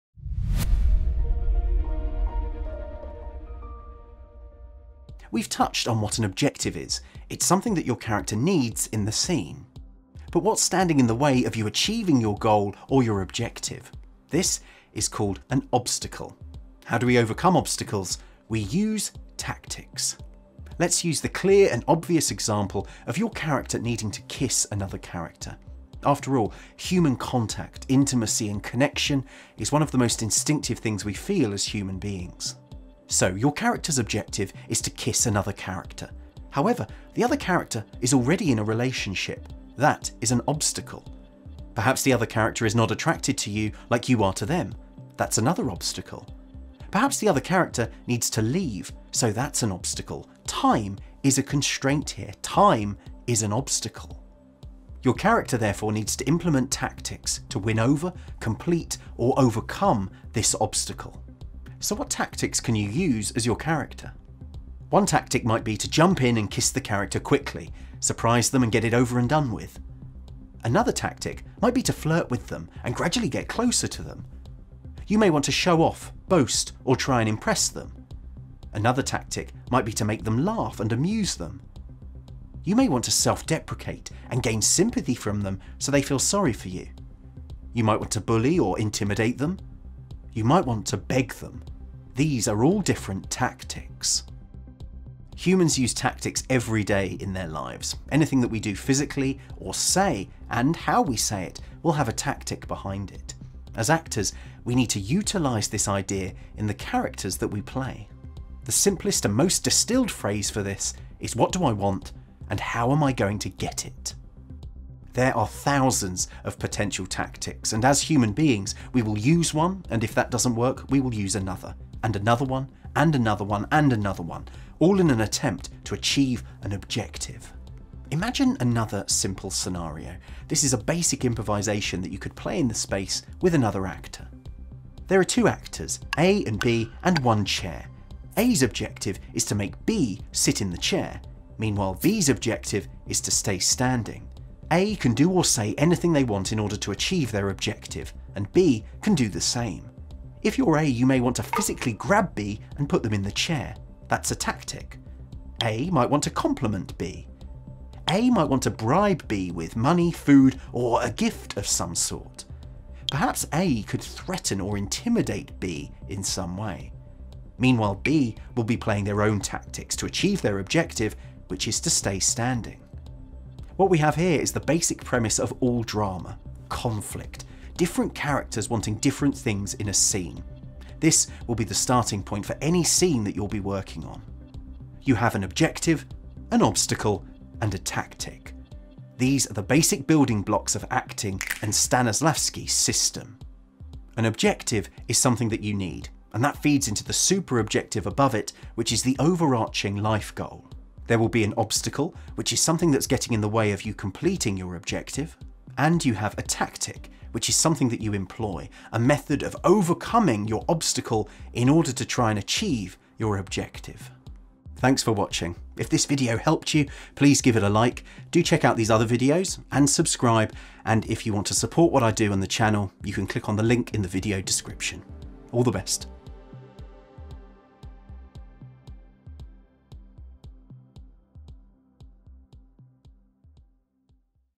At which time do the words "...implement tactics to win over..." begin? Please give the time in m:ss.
0:56.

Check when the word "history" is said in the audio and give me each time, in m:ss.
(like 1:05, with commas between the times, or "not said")
not said.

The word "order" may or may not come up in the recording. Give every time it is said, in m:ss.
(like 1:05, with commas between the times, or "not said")
2:26, 3:31.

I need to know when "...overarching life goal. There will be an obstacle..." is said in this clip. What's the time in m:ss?
3:19.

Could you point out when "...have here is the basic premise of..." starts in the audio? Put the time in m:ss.
2:53.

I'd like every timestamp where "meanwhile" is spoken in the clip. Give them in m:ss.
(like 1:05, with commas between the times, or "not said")
2:21, 2:47.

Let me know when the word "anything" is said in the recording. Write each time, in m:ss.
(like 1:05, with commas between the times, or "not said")
1:38, 2:25.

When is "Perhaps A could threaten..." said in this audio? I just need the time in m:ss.
2:43.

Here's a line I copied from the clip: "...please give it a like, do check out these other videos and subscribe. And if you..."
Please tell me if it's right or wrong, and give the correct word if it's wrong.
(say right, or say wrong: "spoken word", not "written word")
right.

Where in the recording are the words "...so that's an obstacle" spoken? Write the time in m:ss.
0:49.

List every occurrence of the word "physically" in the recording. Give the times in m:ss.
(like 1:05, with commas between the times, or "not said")
1:38, 2:31.